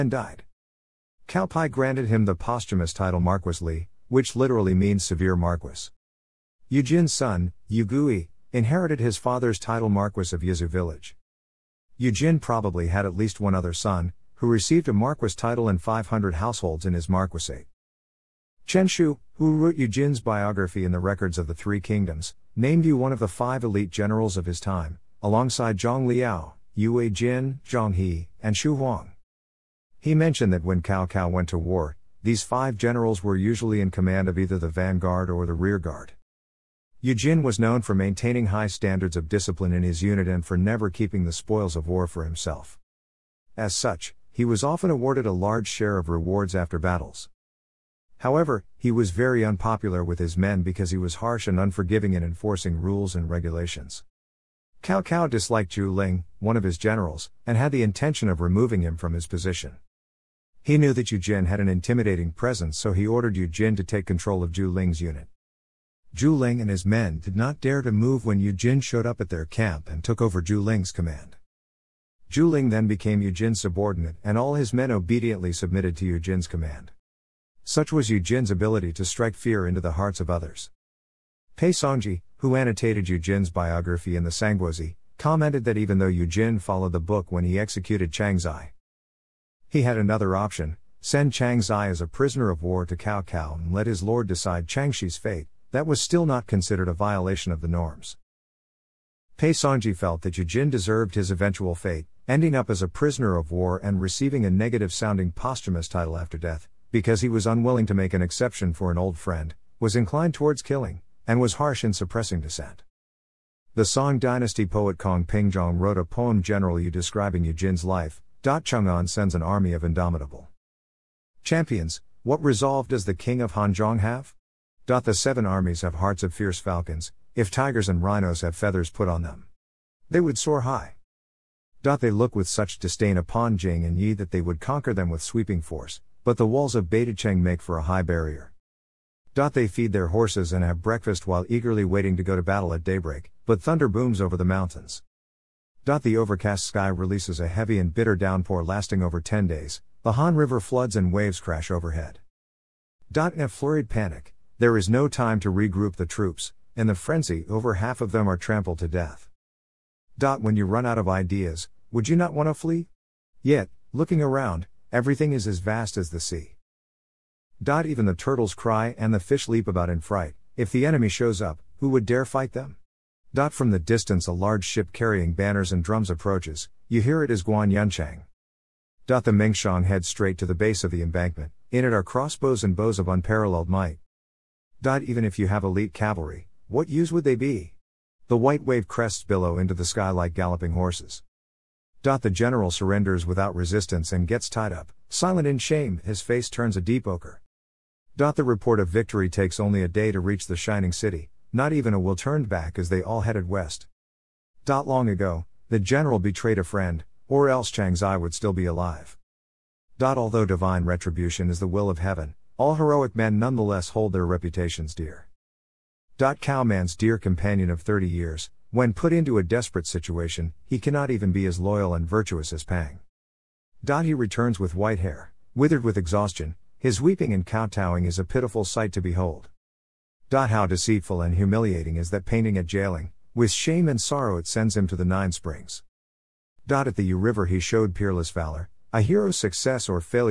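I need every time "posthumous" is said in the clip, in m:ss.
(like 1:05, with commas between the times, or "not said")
0:02, 1:45.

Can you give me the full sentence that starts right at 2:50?
If the enemy shows up, who would dare fight them?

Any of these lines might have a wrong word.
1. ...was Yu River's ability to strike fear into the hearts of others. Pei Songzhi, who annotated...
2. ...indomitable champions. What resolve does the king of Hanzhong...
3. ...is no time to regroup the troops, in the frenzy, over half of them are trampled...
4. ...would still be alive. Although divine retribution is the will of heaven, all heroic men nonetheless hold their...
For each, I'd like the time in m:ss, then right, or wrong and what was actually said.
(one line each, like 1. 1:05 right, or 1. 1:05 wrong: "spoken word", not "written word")
1. 1:17 wrong: "Jin", not "River"
2. 1:59 right
3. 2:34 right
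4. 3:28 right.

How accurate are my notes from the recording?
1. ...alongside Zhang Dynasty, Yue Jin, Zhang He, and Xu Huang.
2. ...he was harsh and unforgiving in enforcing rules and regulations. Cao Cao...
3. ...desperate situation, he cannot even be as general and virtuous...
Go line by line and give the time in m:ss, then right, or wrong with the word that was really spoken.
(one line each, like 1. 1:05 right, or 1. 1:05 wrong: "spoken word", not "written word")
1. 0:25 wrong: "Liao", not "Dynasty"
2. 0:50 right
3. 3:39 wrong: "loyal", not "general".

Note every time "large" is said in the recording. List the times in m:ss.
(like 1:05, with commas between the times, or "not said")
0:45, 2:54.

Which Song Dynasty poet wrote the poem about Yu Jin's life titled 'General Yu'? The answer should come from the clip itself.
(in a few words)
Kong Pingzhong.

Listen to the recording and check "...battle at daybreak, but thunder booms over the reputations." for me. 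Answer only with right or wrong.
wrong.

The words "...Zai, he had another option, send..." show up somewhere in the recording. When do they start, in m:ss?
1:28.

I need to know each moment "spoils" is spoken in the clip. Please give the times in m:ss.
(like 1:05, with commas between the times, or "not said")
0:41.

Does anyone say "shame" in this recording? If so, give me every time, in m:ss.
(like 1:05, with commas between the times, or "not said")
3:15, 3:53.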